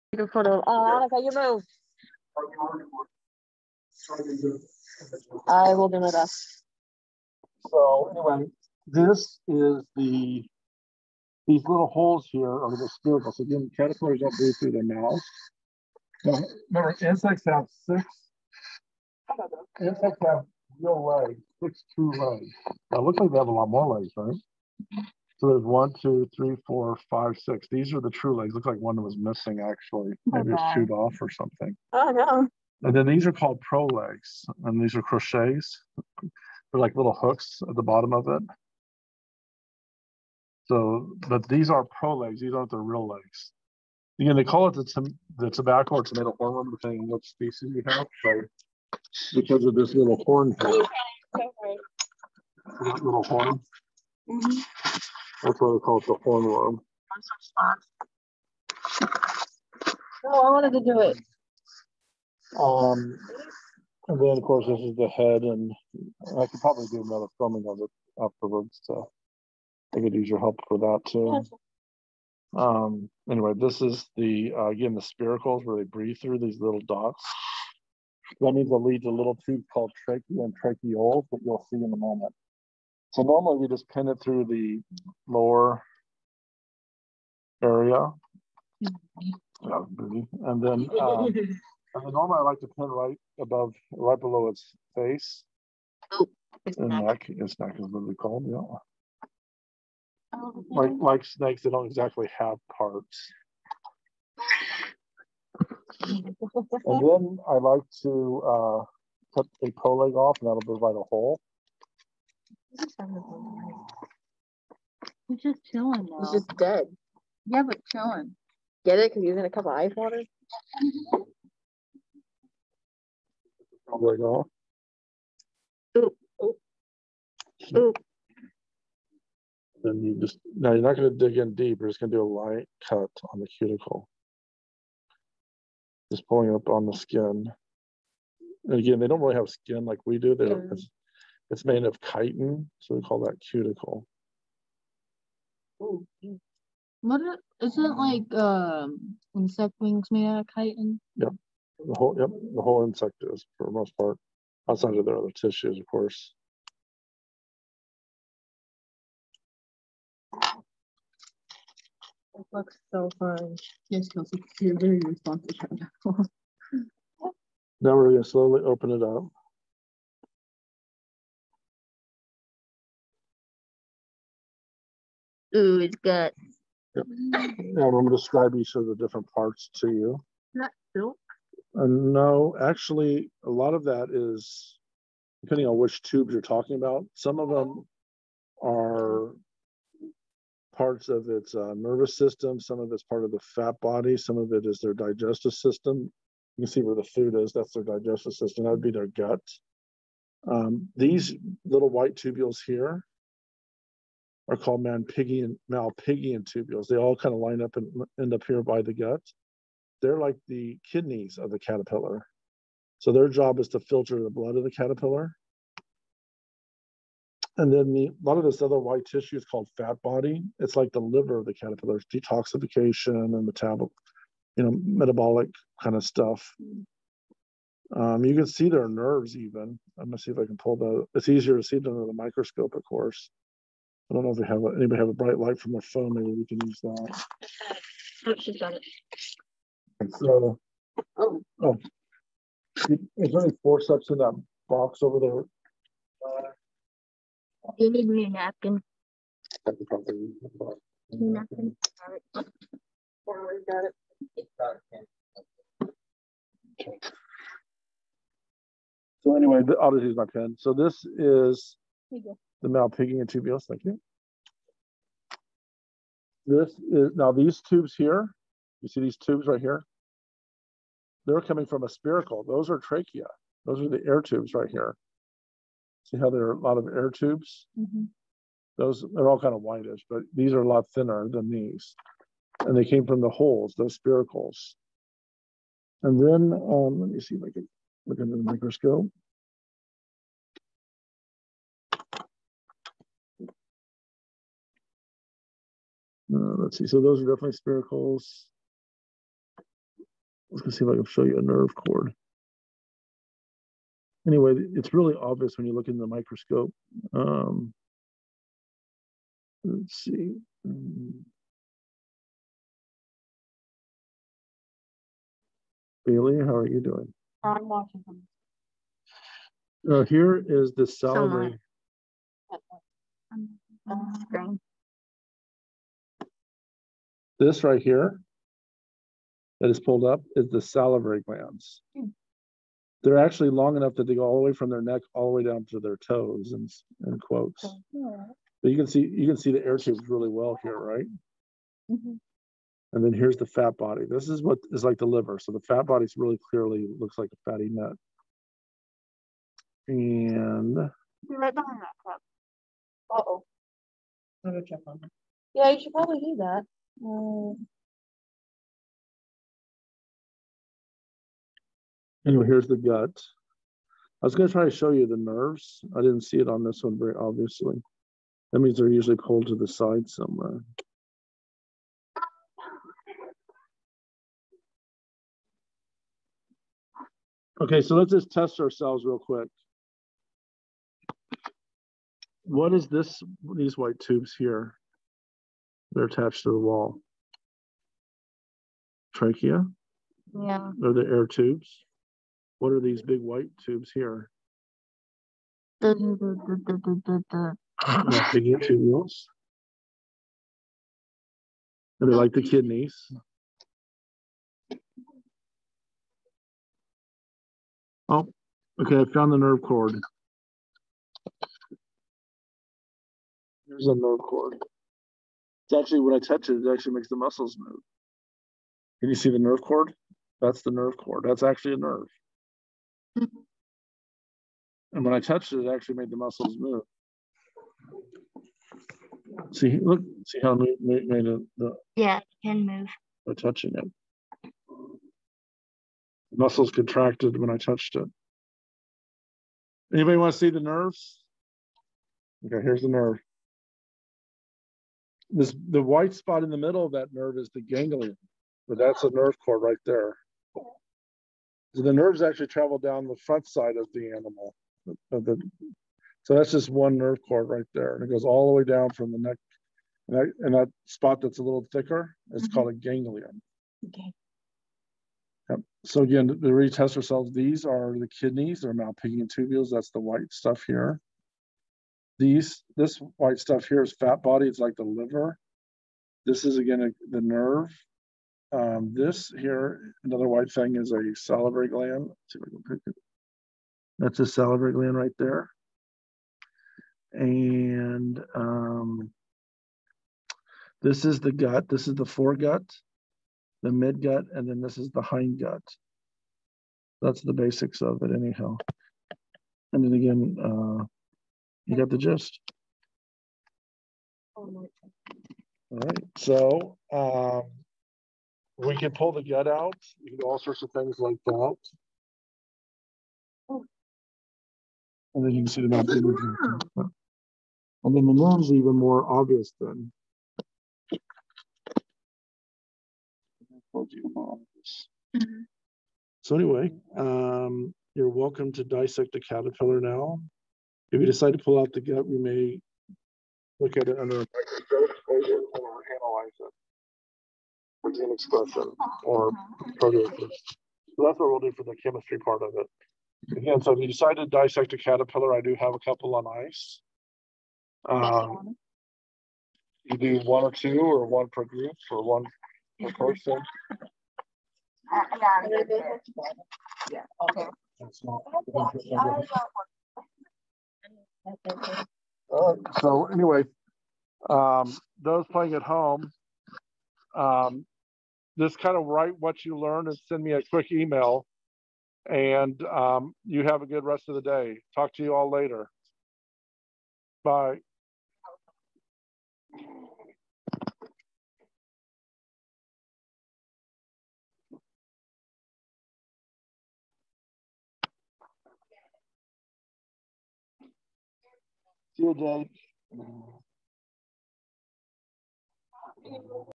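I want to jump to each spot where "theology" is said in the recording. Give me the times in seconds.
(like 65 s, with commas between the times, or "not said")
not said.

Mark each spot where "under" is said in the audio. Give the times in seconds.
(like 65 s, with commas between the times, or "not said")
231 s, 288 s, 533 s.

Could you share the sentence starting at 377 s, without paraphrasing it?
Okay, so let's just test ourselves real quick.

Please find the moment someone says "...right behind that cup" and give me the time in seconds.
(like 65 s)
350 s.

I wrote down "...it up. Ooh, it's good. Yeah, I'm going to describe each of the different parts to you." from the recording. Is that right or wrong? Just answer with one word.
right.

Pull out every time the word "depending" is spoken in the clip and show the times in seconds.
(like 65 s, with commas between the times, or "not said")
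46 s, 185 s.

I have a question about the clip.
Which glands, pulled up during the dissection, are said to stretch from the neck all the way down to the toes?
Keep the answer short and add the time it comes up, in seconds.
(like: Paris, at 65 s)
salivary glands, at 330 s.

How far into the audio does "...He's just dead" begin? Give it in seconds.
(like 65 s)
116 s.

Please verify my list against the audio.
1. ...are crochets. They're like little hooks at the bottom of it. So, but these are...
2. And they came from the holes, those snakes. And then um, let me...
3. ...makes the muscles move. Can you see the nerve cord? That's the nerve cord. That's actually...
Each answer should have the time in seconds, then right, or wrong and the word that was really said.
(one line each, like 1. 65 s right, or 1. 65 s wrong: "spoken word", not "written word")
1. 34 s right
2. 282 s wrong: "spiracles", not "snakes"
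3. 416 s right.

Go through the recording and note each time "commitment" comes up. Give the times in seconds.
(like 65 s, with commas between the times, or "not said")
not said.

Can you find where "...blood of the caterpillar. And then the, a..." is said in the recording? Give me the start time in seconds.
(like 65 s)
214 s.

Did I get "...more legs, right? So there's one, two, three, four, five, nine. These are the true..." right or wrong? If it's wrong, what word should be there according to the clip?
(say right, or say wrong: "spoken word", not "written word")
wrong: "six", not "nine".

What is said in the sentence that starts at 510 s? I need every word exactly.
You can do all sorts of things like that.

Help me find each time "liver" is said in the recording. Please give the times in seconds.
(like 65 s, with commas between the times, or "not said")
221 s, 345 s, 474 s.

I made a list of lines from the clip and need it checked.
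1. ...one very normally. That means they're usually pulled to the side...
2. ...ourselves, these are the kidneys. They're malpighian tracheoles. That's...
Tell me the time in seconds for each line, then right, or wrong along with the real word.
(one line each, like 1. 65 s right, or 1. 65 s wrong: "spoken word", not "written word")
1. 366 s wrong: "obviously", not "normally"
2. 466 s wrong: "tubules", not "tracheoles".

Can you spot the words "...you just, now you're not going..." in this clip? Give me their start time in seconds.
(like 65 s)
130 s.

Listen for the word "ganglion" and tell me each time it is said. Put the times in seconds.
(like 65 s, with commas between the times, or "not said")
447 s, 462 s.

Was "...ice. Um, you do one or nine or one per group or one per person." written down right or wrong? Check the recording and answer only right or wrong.
wrong.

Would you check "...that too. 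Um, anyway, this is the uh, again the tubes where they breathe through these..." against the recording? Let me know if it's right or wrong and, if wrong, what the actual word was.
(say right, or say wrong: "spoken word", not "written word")
wrong: "spiracles", not "tubes".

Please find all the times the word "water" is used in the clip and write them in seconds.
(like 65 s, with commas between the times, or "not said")
119 s.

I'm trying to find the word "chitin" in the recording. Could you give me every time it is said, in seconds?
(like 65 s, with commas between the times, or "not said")
142 s, 150 s.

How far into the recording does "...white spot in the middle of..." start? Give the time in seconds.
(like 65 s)
445 s.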